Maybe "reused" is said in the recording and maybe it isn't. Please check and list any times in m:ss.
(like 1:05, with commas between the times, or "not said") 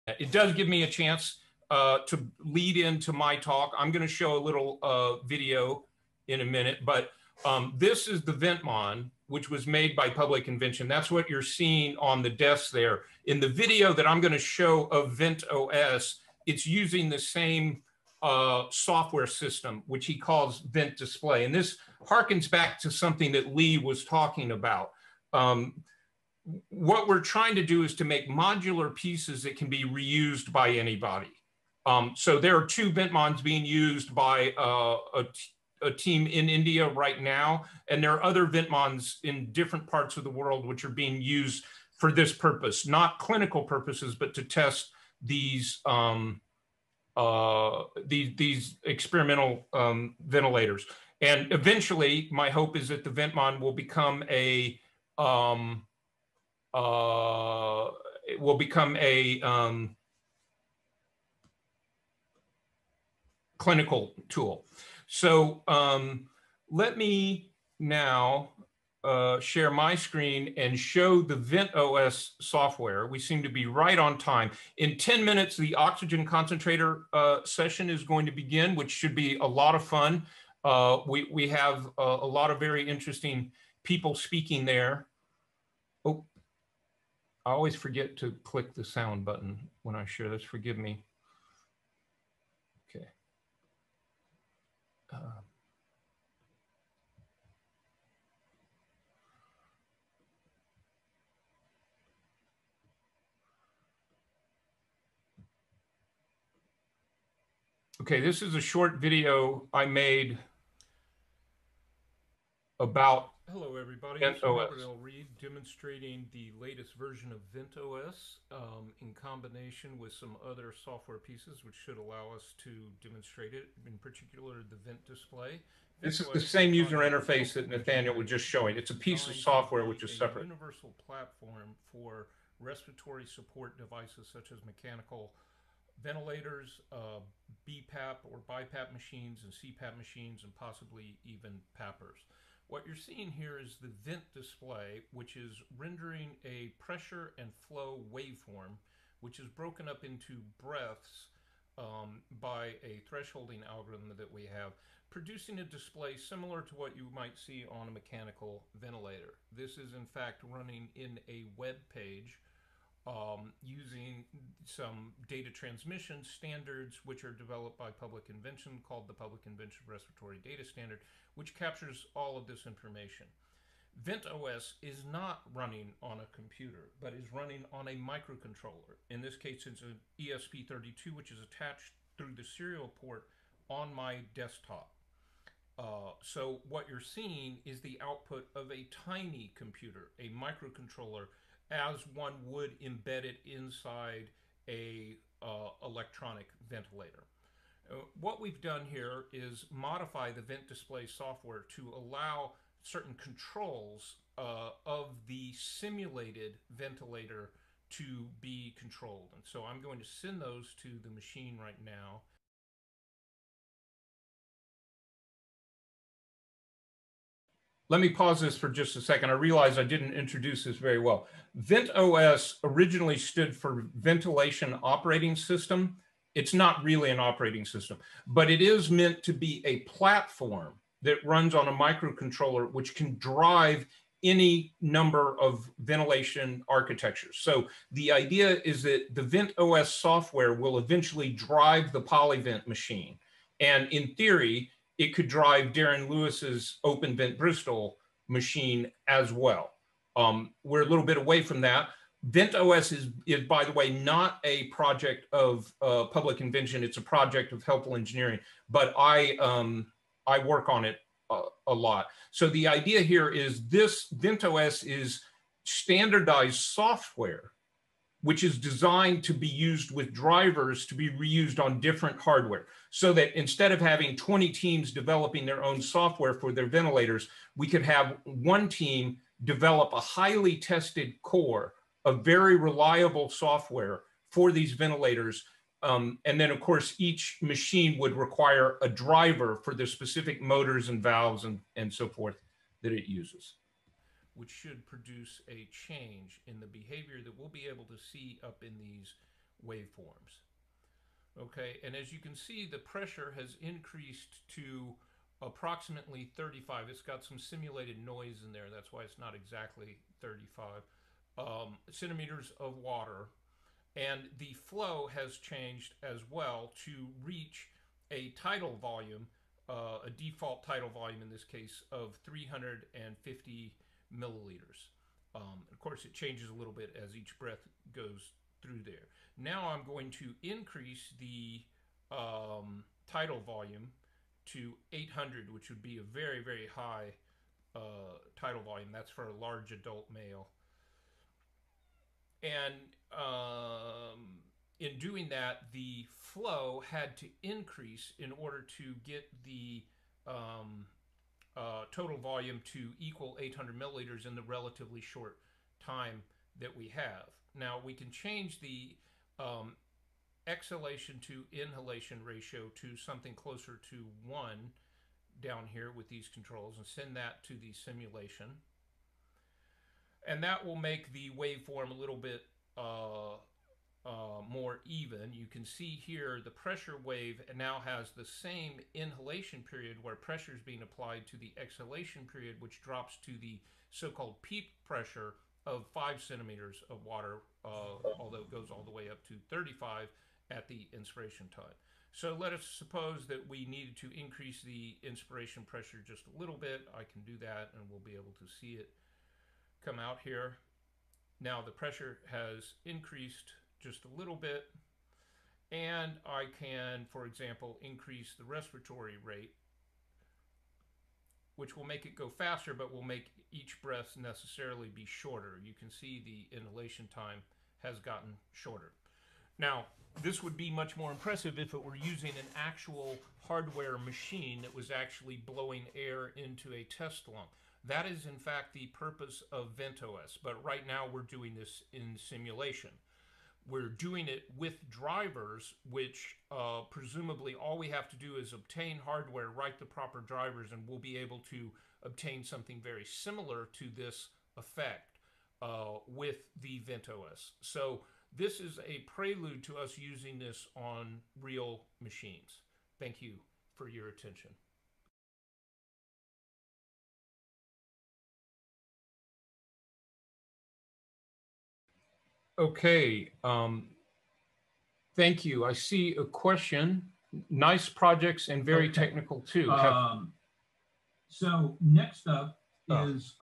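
0:29, 4:31.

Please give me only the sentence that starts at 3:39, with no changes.
I realize I didn't introduce this very well.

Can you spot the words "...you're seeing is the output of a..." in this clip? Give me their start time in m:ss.
3:06.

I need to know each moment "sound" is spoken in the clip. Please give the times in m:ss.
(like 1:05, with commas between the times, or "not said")
1:28.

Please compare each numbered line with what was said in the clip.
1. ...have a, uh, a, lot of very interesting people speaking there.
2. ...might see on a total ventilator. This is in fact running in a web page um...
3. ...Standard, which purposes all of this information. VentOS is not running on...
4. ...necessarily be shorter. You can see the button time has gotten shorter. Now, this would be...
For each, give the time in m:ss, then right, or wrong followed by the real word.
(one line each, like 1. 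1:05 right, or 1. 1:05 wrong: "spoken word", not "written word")
1. 1:21 right
2. 2:37 wrong: "mechanical", not "total"
3. 2:50 wrong: "captures", not "purposes"
4. 6:54 wrong: "inhalation", not "button".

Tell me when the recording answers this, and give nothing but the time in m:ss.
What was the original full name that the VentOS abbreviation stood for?
3:43.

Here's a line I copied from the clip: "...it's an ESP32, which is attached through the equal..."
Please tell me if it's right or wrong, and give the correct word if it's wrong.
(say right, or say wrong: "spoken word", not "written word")
wrong: "serial", not "equal".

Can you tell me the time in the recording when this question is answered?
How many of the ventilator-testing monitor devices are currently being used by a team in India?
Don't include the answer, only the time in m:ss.
0:32.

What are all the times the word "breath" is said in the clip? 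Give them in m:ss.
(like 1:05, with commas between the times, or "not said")
2:30, 5:27, 6:53.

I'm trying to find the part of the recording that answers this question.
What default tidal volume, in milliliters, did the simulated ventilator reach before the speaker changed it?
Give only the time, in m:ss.
5:22.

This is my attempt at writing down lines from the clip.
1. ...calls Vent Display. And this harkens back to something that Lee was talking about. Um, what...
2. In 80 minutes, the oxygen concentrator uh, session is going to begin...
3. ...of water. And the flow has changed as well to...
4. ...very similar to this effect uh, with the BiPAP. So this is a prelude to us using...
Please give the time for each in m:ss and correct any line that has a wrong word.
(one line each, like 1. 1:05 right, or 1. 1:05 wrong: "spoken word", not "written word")
1. 0:20 right
2. 1:14 wrong: "10", not "80"
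3. 5:12 right
4. 7:22 wrong: "VentOS", not "BiPAP".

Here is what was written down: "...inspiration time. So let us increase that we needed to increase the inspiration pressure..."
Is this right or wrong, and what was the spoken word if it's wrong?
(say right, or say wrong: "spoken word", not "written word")
wrong: "suppose", not "increase".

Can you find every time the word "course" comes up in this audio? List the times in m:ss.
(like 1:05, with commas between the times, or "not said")
4:46, 5:25.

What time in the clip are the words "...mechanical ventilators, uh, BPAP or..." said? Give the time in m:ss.
2:14.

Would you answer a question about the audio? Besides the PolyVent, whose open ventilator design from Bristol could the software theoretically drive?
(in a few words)
Darren Lewis.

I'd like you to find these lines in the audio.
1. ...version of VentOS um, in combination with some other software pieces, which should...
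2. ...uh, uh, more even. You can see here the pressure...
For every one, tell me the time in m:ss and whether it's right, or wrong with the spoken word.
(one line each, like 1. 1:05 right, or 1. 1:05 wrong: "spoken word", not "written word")
1. 1:56 right
2. 6:12 right.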